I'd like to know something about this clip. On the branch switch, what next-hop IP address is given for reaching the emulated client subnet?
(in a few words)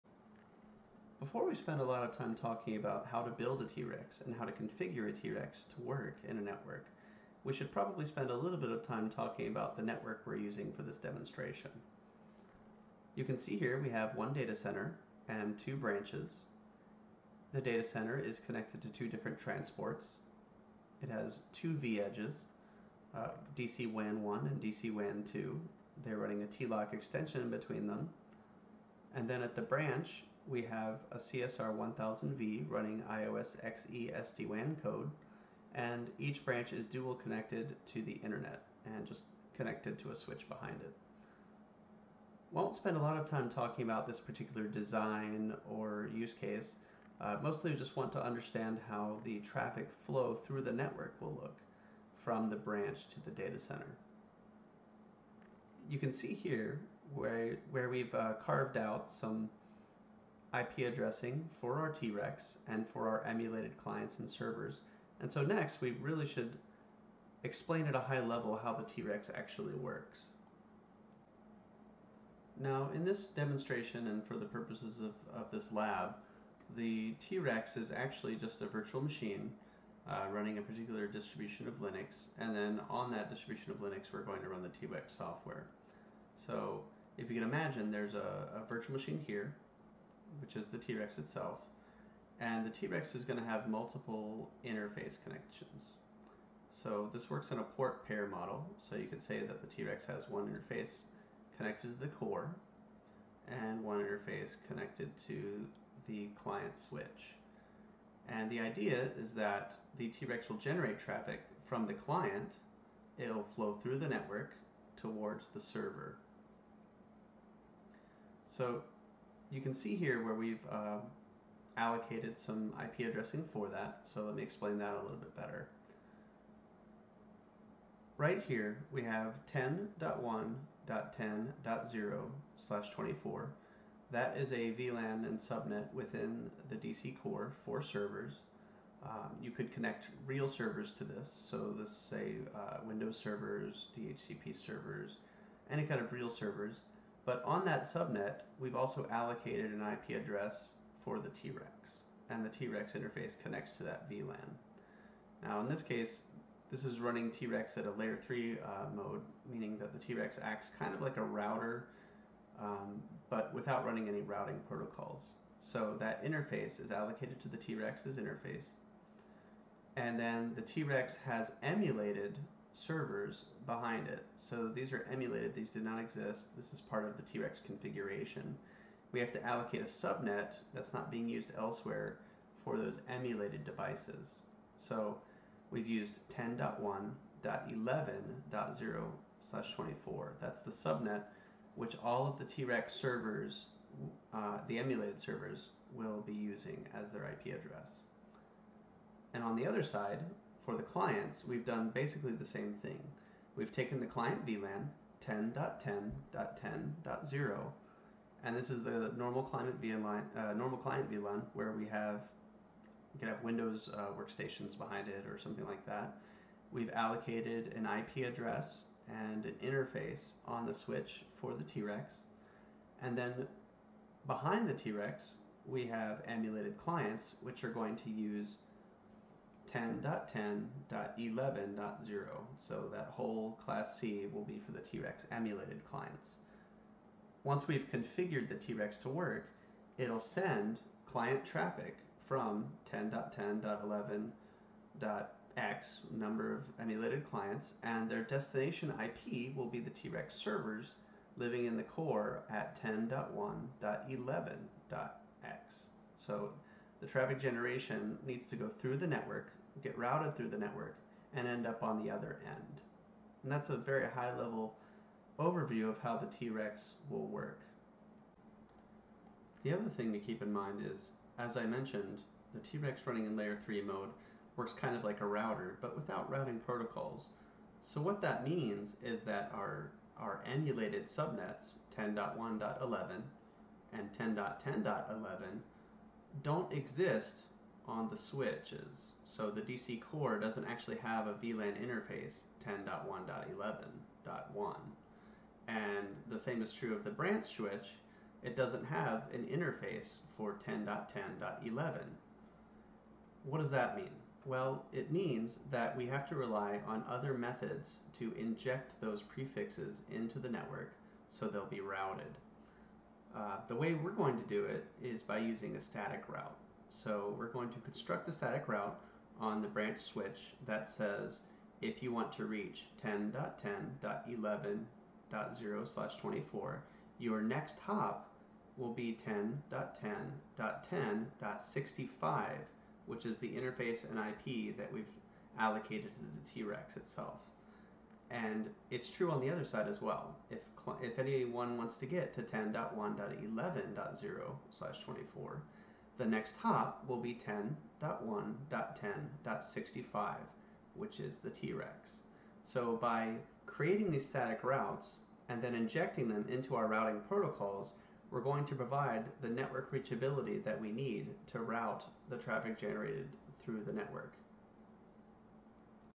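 10.10.10.65.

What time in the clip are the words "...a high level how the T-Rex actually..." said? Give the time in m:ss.
1:07.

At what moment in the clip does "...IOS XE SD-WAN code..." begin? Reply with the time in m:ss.
0:33.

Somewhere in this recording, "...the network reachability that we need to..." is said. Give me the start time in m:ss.
5:59.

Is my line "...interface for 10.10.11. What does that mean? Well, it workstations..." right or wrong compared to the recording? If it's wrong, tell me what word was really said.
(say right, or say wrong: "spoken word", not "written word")
wrong: "means", not "workstations".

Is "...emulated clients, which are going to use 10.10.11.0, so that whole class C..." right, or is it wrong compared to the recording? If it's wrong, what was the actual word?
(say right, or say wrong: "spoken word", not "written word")
right.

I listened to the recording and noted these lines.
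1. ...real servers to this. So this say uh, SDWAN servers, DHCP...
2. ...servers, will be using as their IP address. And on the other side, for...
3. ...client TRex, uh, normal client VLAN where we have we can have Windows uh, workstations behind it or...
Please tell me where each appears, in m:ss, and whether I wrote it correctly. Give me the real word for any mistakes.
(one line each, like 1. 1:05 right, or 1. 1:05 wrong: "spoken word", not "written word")
1. 2:20 wrong: "Windows", not "SDWAN"
2. 3:15 right
3. 3:29 wrong: "VLAN", not "TRex".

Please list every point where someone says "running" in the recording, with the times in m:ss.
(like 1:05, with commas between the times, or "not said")
0:26, 0:32, 1:20, 2:36, 2:43, 4:33.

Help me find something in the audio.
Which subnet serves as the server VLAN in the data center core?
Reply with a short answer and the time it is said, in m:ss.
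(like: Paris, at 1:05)
10.1.10.0/24, at 2:09.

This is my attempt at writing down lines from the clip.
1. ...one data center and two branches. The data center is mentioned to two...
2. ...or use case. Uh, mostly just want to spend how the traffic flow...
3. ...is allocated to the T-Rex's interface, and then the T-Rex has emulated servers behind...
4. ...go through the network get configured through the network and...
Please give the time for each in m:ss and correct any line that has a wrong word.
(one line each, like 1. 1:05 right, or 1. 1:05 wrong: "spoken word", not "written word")
1. 0:14 wrong: "connected", not "mentioned"
2. 0:45 wrong: "understand", not "spend"
3. 2:46 right
4. 4:18 wrong: "routed", not "configured".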